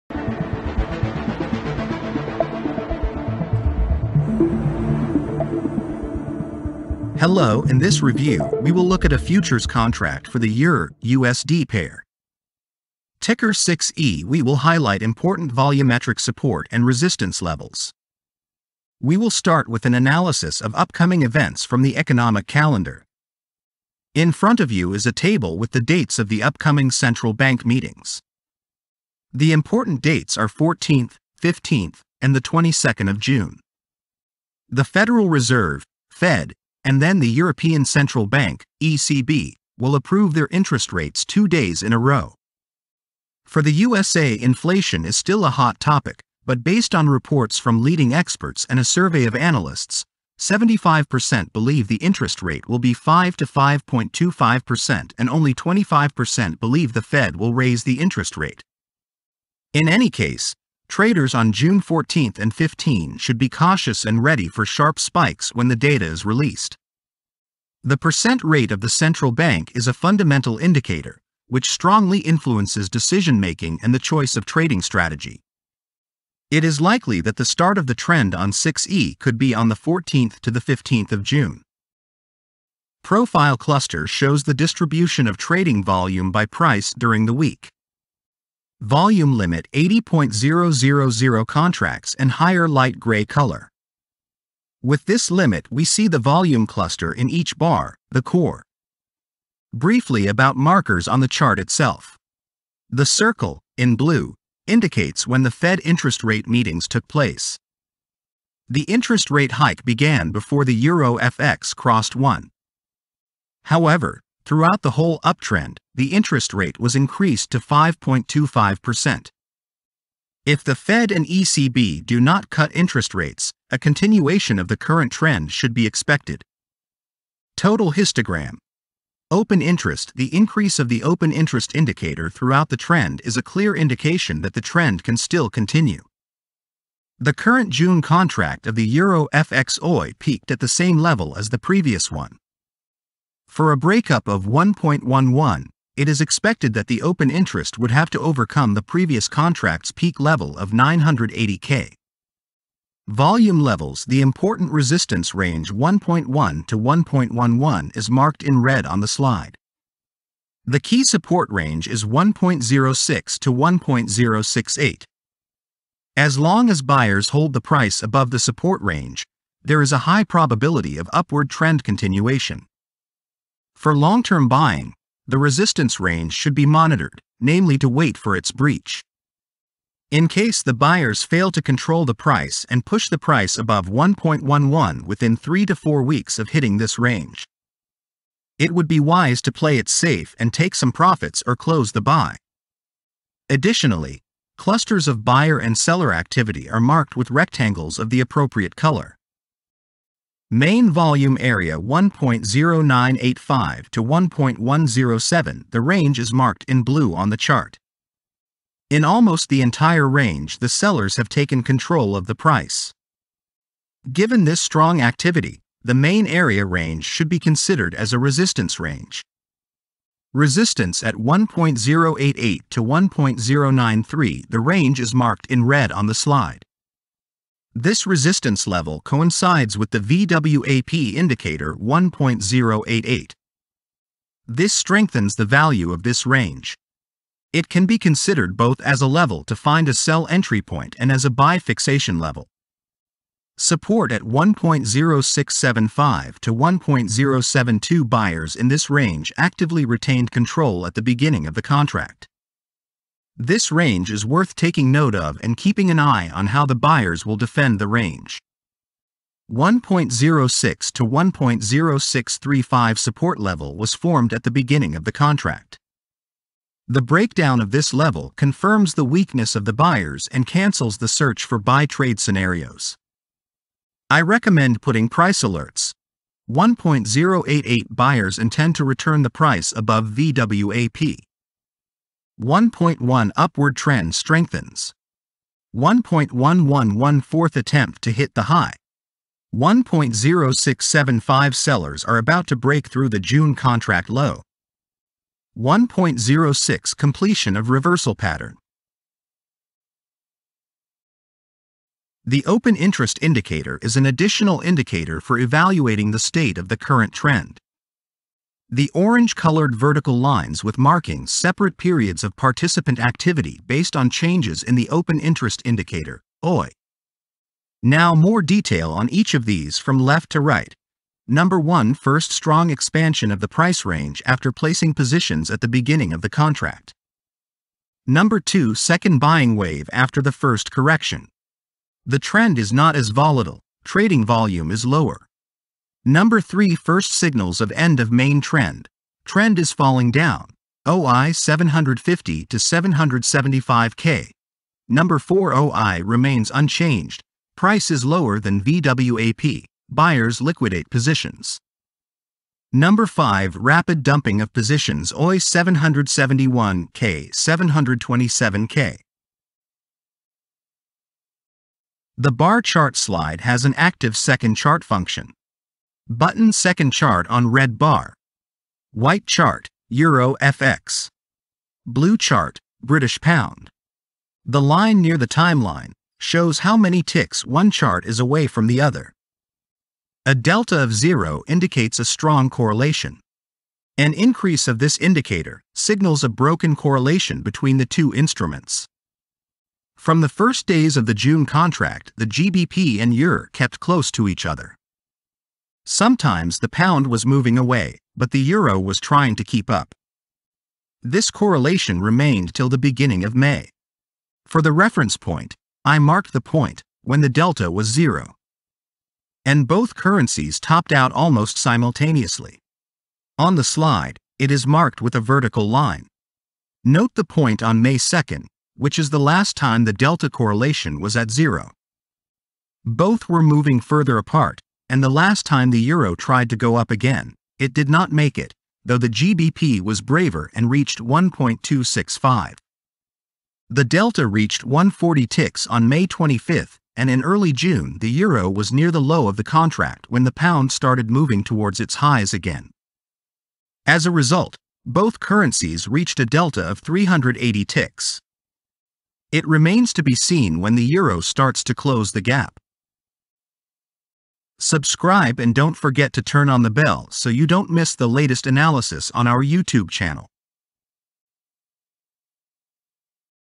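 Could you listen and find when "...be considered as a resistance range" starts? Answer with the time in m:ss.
3:37.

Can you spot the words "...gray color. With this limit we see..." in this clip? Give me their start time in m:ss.
1:32.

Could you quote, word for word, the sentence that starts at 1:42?
The circle, in blue, indicates when the Fed interest rate meetings took place.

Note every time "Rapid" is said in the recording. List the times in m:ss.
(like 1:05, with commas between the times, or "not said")
5:53.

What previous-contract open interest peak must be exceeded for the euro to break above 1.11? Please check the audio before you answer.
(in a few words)
980K.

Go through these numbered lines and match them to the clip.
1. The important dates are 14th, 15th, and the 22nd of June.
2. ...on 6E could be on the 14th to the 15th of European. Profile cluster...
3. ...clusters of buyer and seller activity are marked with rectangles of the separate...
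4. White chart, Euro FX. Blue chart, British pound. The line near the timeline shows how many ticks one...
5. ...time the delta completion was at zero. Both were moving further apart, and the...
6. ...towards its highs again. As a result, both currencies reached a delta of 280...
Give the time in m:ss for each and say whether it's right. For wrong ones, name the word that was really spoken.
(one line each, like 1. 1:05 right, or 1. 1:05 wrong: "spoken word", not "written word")
1. 0:29 right
2. 1:18 wrong: "June", not "European"
3. 3:14 wrong: "appropriate", not "separate"
4. 6:08 right
5. 6:59 wrong: "correlation", not "completion"
6. 7:21 wrong: "380", not "280".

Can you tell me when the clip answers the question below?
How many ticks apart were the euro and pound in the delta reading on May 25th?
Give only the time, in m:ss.
7:14.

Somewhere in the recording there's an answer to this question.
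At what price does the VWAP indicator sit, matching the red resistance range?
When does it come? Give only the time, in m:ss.
3:50.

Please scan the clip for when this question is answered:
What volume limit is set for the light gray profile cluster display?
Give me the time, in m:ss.
1:29.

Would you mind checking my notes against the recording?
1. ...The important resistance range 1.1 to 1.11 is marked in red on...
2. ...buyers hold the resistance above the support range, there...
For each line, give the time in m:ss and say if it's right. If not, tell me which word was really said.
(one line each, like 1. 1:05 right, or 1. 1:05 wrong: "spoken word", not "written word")
1. 2:34 right
2. 2:46 wrong: "price", not "resistance".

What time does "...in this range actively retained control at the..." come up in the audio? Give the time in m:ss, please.
4:08.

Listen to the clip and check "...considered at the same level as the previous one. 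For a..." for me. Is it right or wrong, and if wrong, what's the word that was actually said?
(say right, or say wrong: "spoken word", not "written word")
wrong: "peaked", not "considered".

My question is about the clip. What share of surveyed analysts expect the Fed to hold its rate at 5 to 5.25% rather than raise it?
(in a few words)
75%.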